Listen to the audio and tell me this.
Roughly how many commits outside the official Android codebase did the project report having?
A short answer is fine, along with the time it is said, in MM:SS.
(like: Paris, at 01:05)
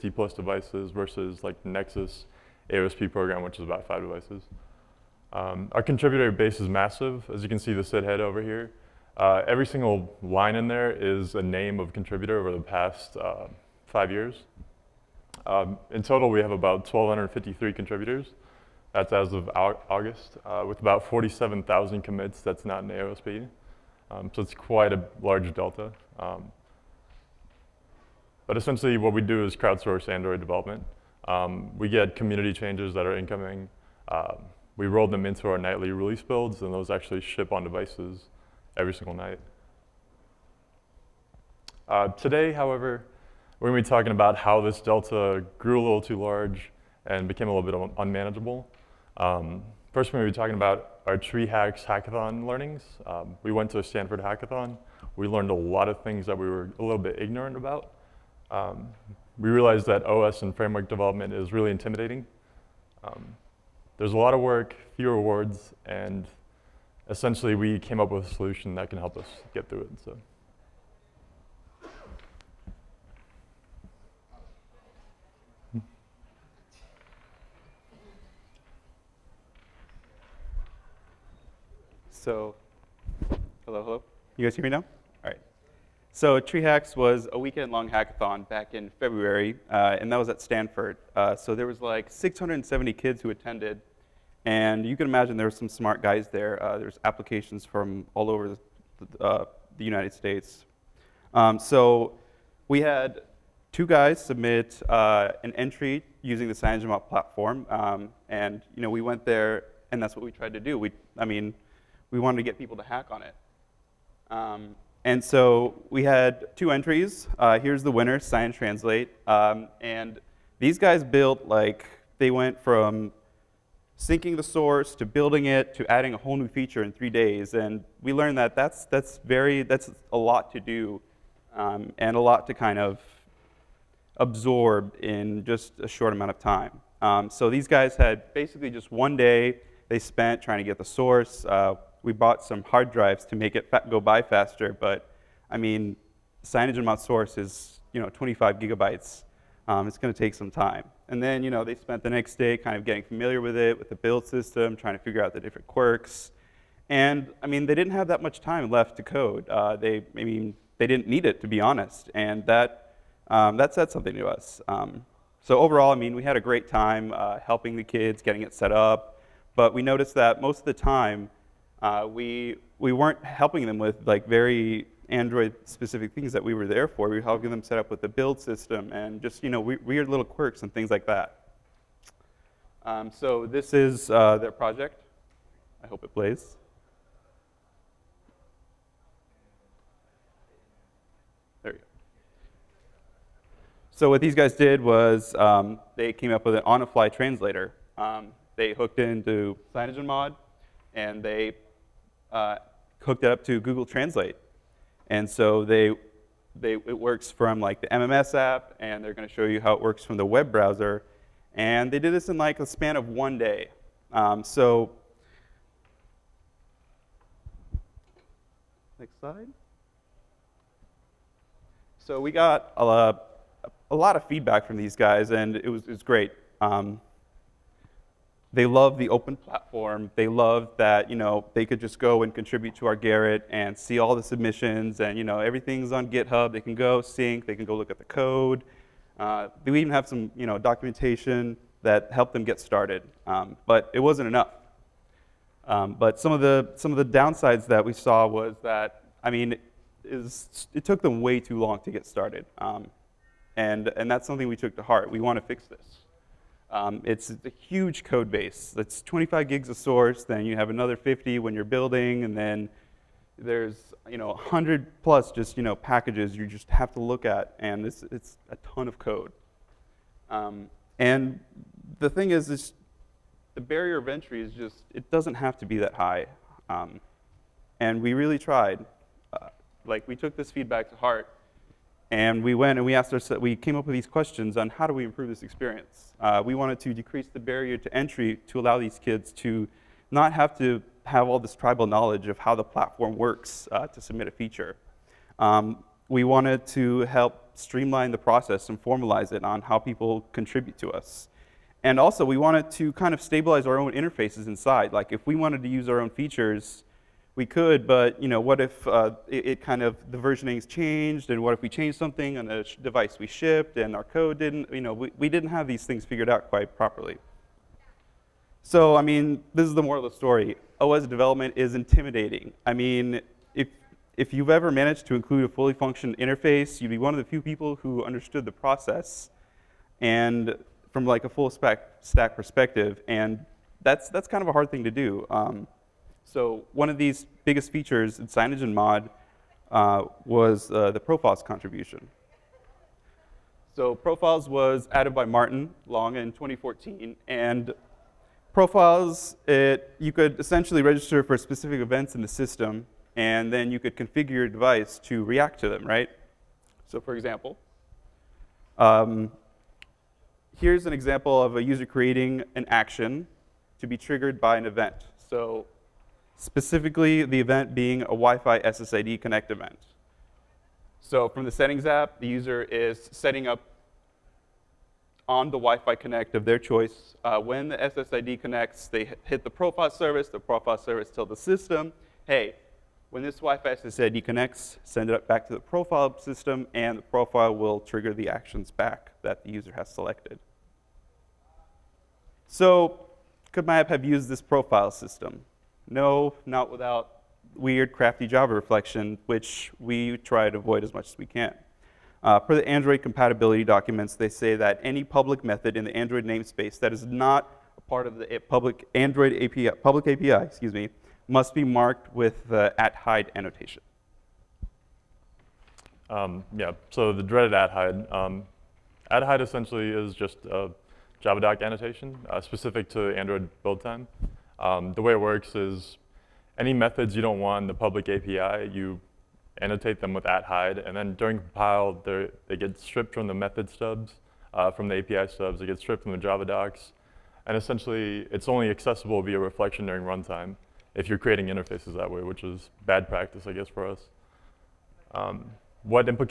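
47,000, at 00:21.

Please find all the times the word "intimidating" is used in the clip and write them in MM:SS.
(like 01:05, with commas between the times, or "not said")
01:01, 05:21.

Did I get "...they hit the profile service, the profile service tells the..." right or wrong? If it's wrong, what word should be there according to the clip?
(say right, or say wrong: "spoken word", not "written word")
right.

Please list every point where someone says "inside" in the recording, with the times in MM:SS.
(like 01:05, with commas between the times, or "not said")
05:04.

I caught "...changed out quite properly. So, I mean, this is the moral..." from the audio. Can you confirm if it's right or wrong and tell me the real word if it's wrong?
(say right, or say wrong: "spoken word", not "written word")
wrong: "figured", not "changed".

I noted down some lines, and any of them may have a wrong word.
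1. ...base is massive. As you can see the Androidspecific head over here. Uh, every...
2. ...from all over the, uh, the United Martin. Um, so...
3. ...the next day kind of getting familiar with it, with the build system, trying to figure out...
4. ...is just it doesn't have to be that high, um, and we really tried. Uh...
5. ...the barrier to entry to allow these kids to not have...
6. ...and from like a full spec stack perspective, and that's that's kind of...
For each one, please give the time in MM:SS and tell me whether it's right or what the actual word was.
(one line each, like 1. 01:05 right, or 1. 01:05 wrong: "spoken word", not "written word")
1. 00:06 wrong: "Cid", not "Androidspecific"
2. 01:37 wrong: "States", not "Martin"
3. 02:32 right
4. 04:34 right
5. 04:47 right
6. 05:30 right.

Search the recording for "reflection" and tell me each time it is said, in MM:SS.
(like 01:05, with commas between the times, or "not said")
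06:38, 07:19.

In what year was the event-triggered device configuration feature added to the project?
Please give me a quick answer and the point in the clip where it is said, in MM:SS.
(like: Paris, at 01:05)
2014, at 05:46.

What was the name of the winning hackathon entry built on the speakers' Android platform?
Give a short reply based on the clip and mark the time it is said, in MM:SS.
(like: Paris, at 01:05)
Science Translate, at 01:58.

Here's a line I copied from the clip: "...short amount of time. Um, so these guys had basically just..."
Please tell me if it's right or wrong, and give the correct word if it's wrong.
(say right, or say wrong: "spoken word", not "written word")
right.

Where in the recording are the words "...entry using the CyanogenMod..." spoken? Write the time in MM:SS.
01:45.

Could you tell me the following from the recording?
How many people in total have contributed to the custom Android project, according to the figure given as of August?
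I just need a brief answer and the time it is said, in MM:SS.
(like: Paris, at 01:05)
1,253, at 00:16.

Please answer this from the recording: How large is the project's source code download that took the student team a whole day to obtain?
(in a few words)
25 gigabytes.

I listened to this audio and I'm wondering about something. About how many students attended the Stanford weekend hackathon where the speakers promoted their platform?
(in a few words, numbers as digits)
670.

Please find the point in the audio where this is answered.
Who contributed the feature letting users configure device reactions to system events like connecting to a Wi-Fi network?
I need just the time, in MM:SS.
05:45.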